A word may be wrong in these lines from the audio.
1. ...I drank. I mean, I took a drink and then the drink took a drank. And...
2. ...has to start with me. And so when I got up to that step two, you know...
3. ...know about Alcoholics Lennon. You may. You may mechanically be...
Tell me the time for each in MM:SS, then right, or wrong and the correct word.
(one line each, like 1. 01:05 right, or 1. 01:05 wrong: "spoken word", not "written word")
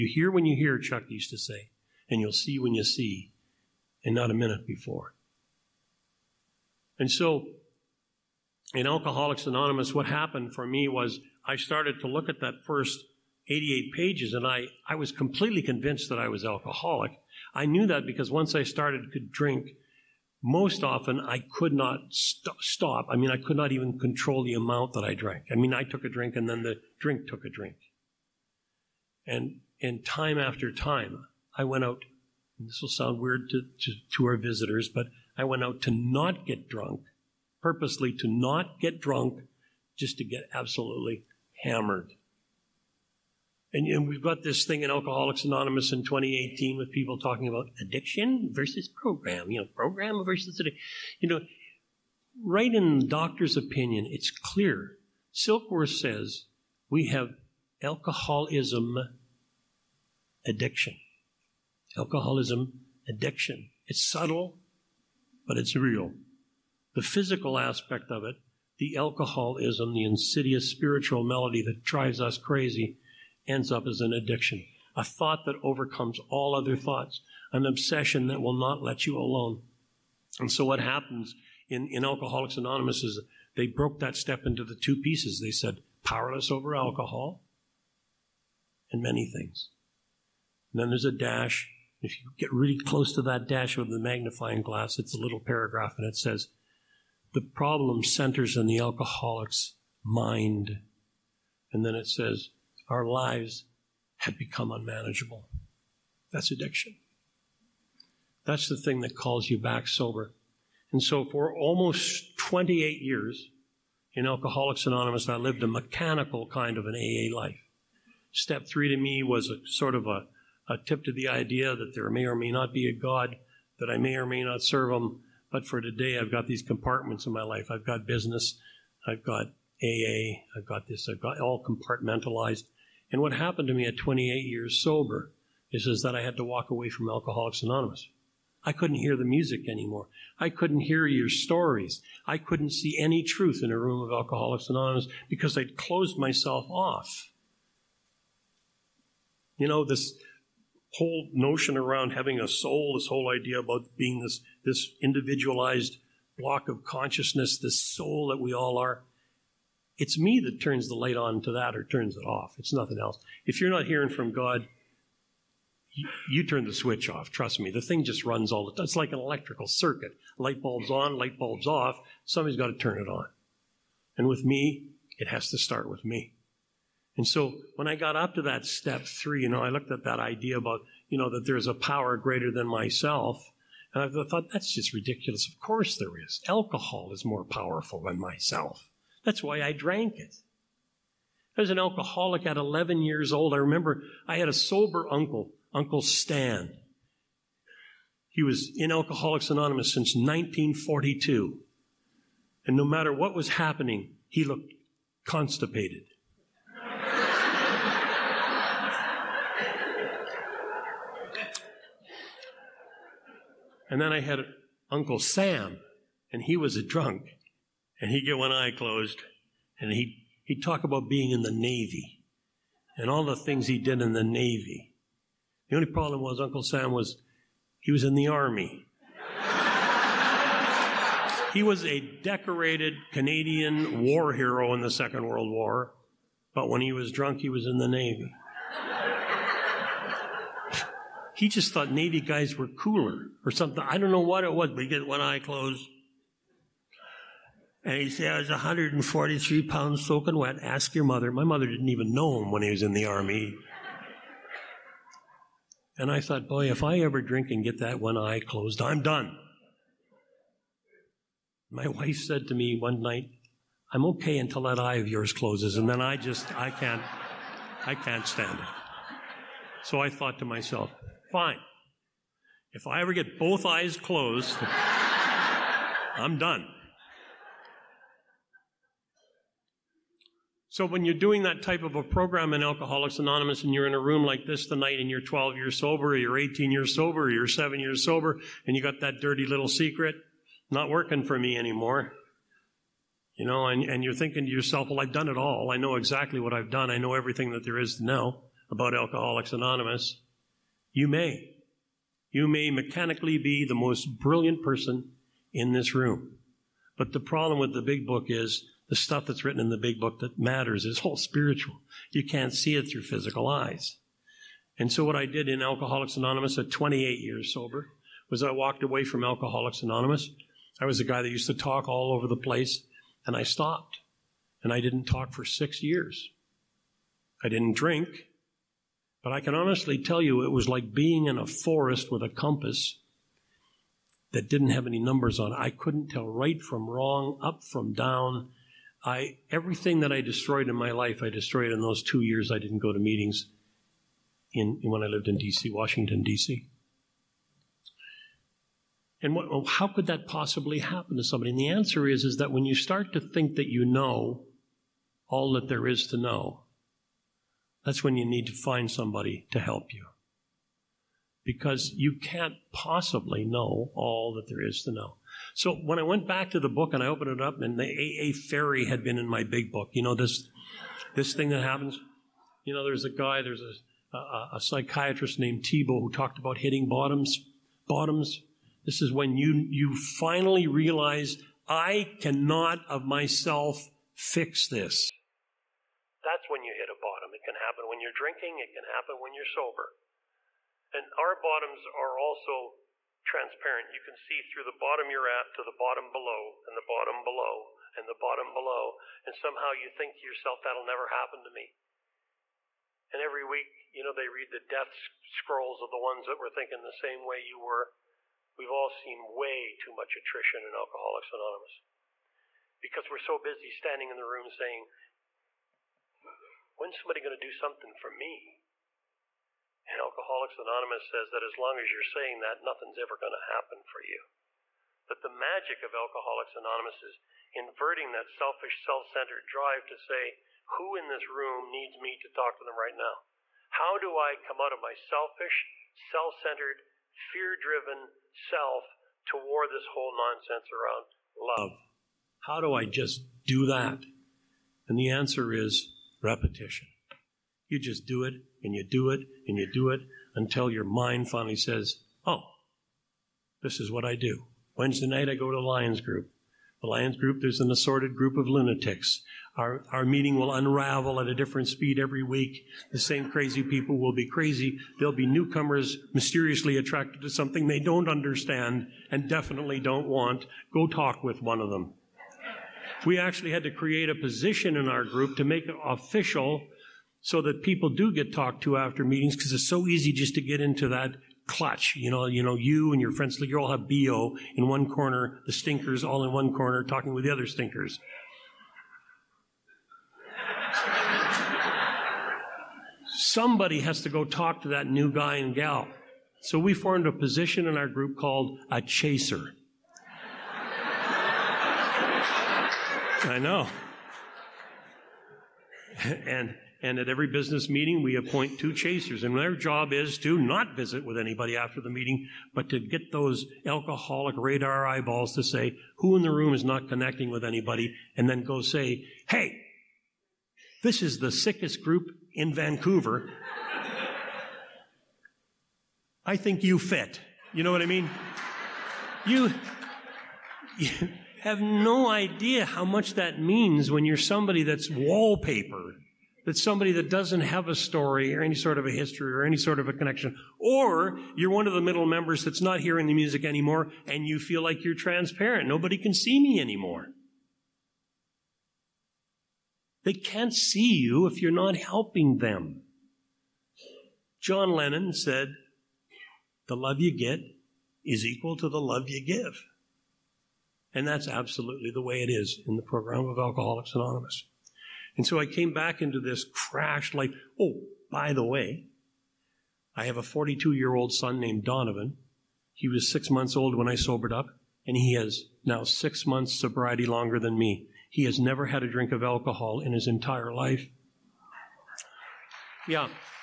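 1. 00:25 wrong: "drink", not "drank"
2. 02:55 wrong: "three", not "two"
3. 04:58 wrong: "Anonymous", not "Lennon".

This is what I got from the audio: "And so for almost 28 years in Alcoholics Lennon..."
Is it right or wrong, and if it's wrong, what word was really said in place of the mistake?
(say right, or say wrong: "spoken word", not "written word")
wrong: "Anonymous", not "Lennon".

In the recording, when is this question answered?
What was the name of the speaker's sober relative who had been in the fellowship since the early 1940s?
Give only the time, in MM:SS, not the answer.
03:15.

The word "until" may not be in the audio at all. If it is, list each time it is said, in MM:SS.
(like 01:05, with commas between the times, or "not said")
04:24, 07:30.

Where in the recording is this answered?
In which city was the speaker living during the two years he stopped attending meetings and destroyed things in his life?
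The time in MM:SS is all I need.
05:45.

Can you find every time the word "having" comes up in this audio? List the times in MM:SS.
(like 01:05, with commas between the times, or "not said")
02:32.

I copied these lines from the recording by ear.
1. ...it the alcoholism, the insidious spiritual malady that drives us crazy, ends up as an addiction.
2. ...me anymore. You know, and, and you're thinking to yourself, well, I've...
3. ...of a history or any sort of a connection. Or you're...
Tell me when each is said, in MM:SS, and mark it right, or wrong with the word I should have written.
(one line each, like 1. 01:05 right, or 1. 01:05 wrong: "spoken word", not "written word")
1. 01:08 right
2. 04:51 right
3. 08:58 right.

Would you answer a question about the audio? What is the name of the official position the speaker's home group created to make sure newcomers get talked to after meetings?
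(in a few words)
chaser.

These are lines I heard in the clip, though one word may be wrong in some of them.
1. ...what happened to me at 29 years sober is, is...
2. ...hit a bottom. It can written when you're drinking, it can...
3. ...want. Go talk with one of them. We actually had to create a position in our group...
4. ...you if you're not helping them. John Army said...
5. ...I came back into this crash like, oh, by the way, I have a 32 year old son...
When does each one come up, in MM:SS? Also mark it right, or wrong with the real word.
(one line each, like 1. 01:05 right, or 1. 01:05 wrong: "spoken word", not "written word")
1. 02:13 wrong: "28", not "29"
2. 06:26 wrong: "happen", not "written"
3. 07:50 right
4. 09:10 wrong: "Lennon", not "Army"
5. 09:25 wrong: "42", not "32".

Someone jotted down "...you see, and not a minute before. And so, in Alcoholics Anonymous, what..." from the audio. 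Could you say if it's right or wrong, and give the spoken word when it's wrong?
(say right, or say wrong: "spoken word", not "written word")
right.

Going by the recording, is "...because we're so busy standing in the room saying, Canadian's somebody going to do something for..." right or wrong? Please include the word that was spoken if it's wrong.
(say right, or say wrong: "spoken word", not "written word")
wrong: "When", not "Canadian".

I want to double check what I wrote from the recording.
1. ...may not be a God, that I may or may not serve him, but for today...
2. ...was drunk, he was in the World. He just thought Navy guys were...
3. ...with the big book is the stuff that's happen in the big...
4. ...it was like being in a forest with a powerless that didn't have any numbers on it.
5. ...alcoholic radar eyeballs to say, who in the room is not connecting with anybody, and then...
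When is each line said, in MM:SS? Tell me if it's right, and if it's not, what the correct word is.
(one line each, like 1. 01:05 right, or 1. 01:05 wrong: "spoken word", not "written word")
1. 02:02 right
2. 03:56 wrong: "Navy", not "World"
3. 05:07 wrong: "written", not "happen"
4. 05:30 wrong: "compass", not "powerless"
5. 08:33 right.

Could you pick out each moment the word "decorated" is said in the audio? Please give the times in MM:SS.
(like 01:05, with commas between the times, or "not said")
03:52.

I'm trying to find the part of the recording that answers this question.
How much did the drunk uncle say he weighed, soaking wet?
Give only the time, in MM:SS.
04:08.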